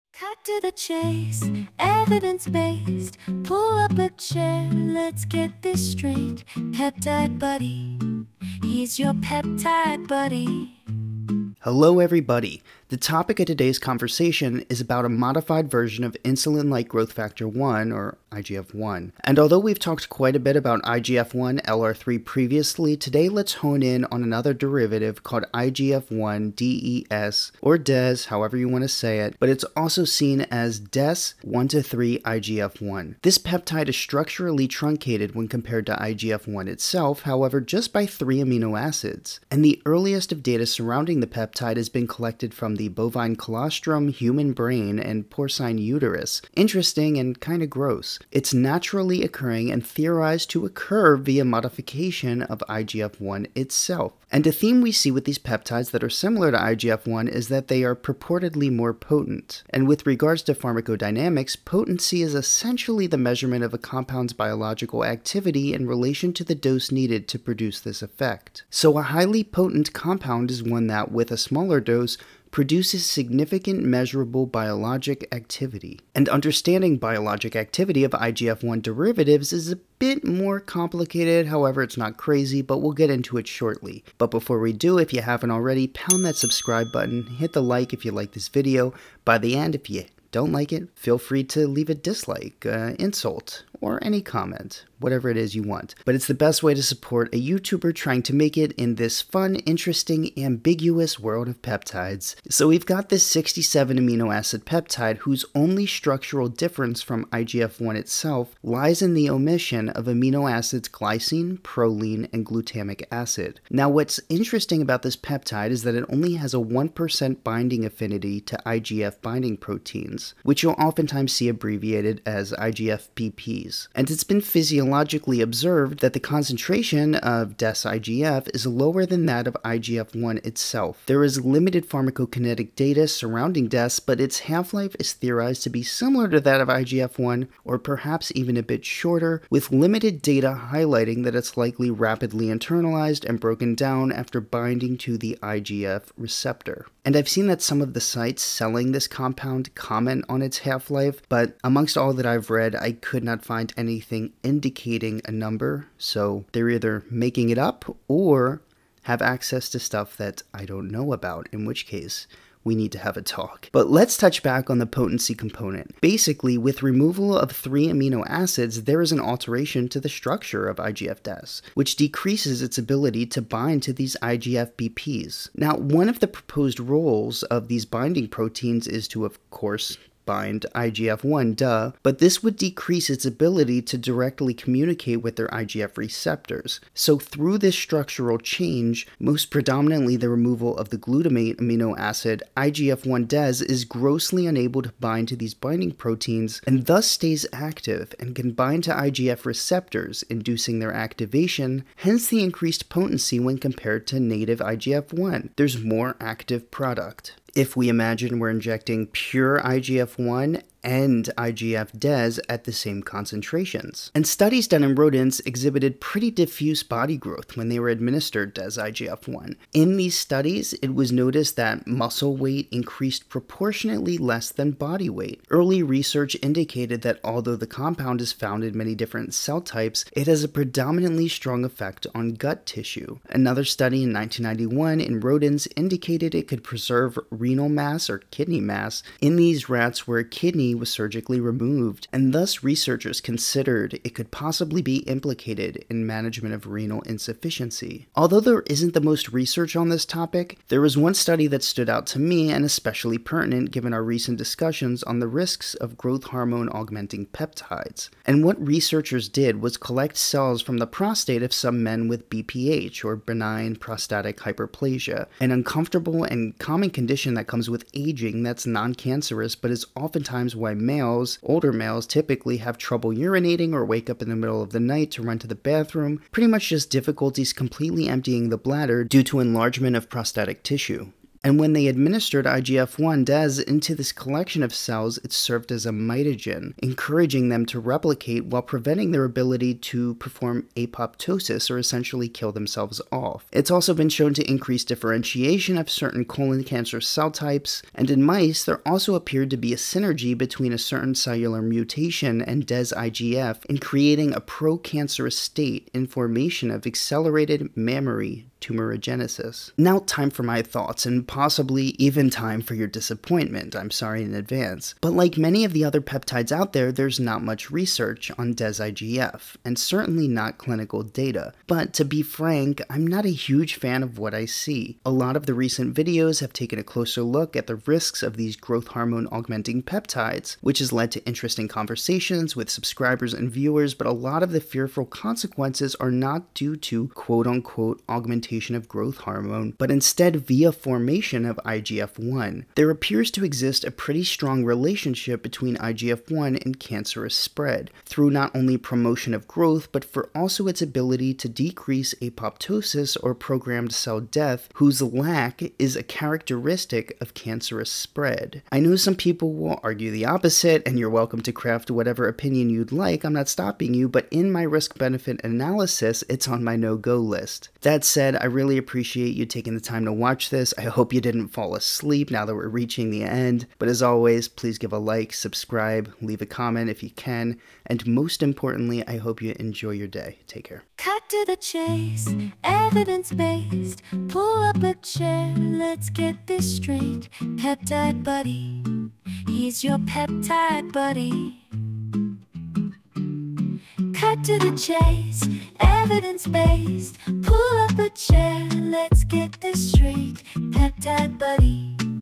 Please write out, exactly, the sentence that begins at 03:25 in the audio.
There's more active product if we imagine we're injecting pure IGF 1 and IGF Des at the same concentrations.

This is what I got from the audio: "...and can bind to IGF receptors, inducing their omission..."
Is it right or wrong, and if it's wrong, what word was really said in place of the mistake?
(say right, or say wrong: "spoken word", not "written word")
wrong: "activation", not "omission".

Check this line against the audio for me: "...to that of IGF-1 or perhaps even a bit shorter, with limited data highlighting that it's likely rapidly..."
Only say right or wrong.
right.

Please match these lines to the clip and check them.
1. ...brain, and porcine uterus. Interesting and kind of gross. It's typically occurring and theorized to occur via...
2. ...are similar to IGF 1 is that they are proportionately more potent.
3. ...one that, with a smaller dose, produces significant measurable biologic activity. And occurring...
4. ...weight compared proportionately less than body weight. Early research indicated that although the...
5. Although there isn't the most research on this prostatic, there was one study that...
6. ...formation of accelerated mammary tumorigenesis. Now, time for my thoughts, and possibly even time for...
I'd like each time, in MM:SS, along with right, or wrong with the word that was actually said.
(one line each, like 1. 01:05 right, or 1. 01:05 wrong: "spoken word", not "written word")
1. 00:44 wrong: "naturally", not "typically"
2. 00:56 wrong: "purportedly", not "proportionately"
3. 01:10 wrong: "understanding", not "occurring"
4. 03:42 wrong: "increased", not "compared"
5. 04:08 wrong: "topic", not "prostatic"
6. 05:06 right.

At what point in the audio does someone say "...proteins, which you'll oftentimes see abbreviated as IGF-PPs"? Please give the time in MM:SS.
01:59.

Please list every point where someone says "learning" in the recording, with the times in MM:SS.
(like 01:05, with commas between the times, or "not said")
not said.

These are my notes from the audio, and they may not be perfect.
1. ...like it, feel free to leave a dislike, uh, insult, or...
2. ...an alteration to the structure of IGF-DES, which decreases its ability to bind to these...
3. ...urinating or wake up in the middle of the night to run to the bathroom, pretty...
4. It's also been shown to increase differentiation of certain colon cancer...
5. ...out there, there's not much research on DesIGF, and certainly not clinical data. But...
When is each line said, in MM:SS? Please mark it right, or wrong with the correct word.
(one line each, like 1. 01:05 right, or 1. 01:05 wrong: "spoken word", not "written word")
1. 01:30 right
2. 02:49 right
3. 04:33 right
4. 04:53 right
5. 05:16 right.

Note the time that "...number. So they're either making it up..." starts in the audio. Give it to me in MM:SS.
02:35.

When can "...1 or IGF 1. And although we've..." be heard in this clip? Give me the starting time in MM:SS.
00:17.